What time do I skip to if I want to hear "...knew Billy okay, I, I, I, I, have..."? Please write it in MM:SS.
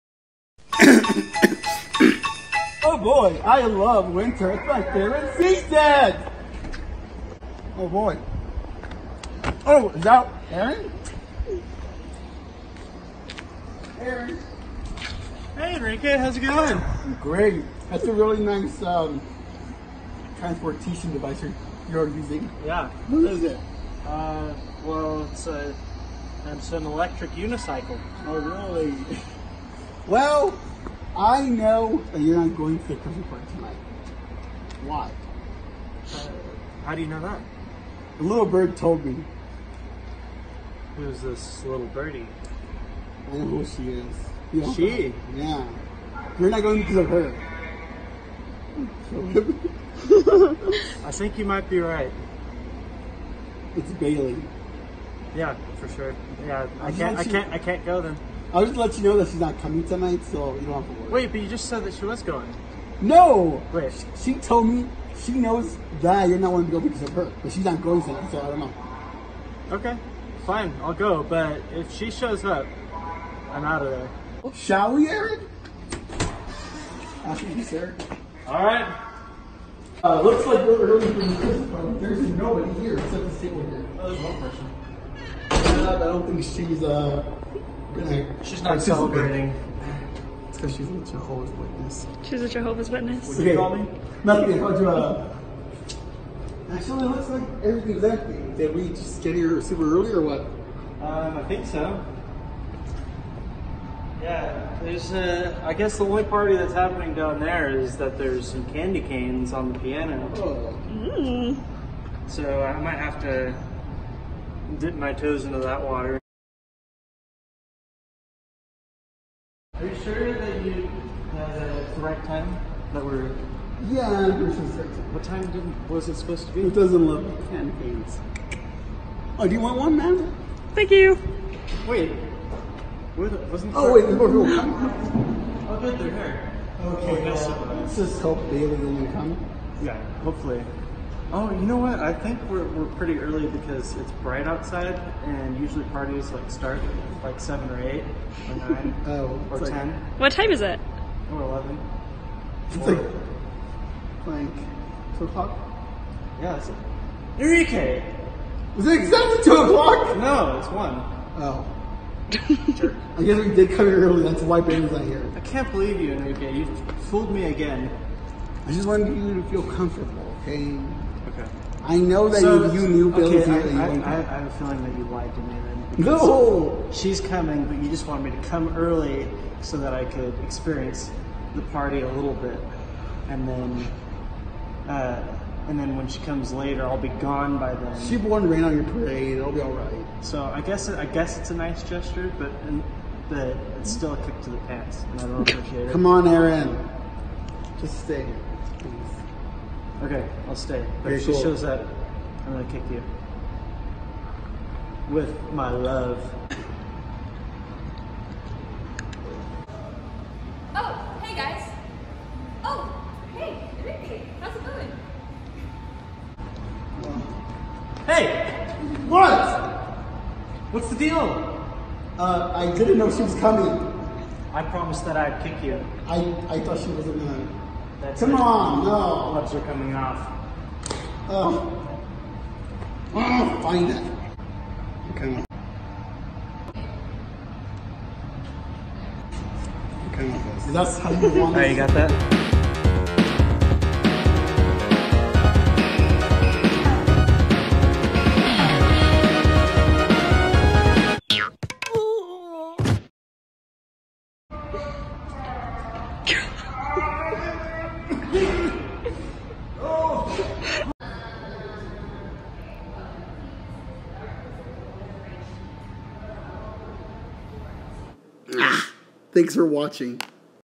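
02:52.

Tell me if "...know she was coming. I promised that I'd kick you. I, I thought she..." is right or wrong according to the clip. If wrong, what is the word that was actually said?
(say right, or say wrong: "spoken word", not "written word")
right.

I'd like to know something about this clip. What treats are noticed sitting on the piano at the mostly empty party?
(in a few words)
Candy canes.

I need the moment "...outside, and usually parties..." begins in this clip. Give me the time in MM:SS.
02:24.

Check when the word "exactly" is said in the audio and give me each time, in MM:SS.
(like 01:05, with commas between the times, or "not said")
01:37, 02:39.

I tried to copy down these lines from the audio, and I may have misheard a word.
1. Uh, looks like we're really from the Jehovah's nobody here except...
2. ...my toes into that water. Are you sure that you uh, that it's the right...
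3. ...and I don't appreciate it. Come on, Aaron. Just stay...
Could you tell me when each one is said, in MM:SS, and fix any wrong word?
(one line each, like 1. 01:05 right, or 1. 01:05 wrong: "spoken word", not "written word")
1. 01:20 wrong: "There", not "Jehovah"
2. 01:54 right
3. 03:15 right.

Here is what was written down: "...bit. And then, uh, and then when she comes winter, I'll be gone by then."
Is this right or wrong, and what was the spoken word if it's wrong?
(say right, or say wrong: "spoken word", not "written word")
wrong: "later", not "winter".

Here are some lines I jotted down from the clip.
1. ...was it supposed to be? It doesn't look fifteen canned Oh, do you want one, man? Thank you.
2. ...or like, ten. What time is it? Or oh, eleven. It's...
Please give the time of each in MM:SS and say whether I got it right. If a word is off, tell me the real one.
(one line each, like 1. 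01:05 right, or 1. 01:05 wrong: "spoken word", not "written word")
1. 02:05 wrong: "ten", not "fifteen"
2. 02:29 right.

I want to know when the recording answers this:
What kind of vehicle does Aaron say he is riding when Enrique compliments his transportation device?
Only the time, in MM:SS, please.
00:26.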